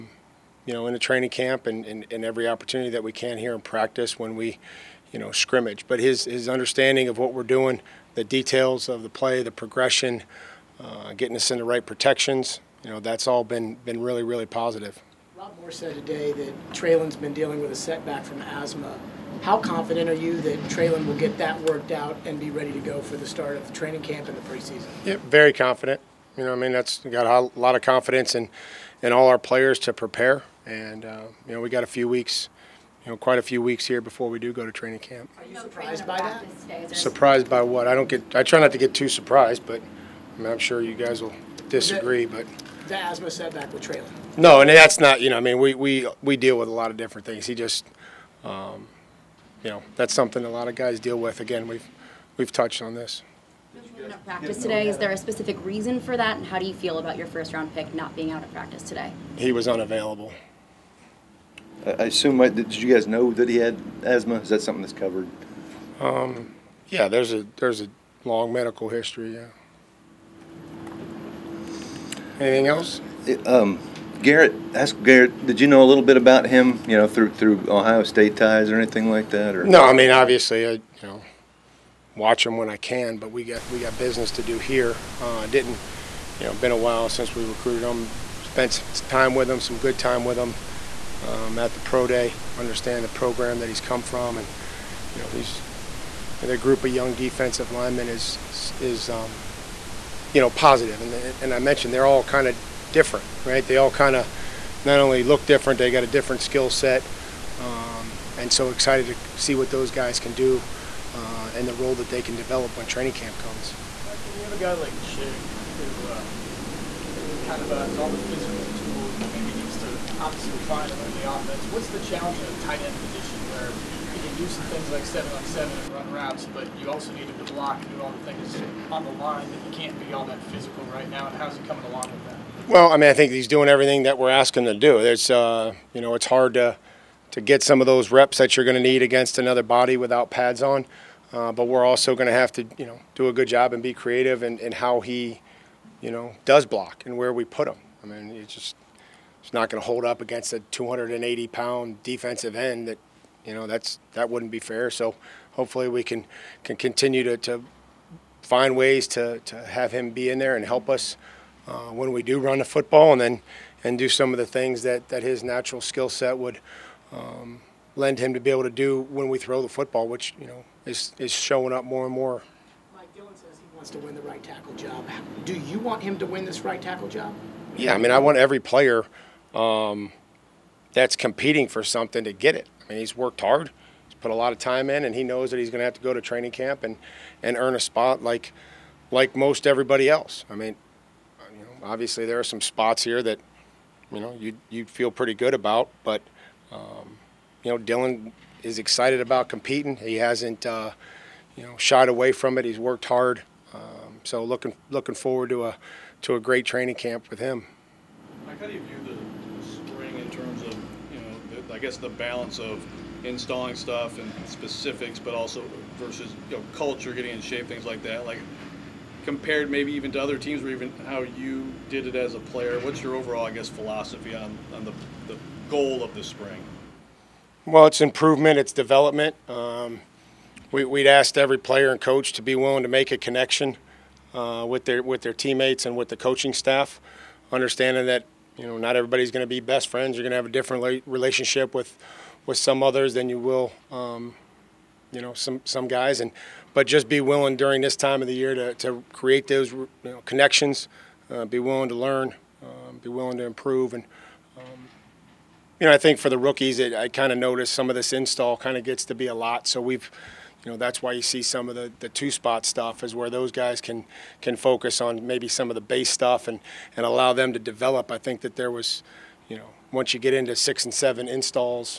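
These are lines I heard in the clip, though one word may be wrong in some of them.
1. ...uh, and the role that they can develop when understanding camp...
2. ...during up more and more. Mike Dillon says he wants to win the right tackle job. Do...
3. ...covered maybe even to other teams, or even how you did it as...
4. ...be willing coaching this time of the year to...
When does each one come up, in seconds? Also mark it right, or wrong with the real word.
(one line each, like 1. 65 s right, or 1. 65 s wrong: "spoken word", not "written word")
1. 111 s wrong: "training", not "understanding"
2. 171 s wrong: "showing", not "during"
3. 219 s wrong: "compared", not "covered"
4. 247 s wrong: "during", not "coaching".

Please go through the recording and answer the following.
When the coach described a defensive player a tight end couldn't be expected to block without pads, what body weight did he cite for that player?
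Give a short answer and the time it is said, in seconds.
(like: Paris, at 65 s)
280 pounds, at 150 s.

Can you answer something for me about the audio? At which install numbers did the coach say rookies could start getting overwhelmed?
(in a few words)
6 and 7.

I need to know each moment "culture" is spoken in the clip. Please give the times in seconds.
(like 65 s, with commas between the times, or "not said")
216 s.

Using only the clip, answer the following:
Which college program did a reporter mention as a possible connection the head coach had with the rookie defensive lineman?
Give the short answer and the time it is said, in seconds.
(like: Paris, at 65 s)
Ohio State, at 77 s.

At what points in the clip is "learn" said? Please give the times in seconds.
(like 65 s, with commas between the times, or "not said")
121 s, 251 s.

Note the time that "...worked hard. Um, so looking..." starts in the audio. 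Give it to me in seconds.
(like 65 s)
202 s.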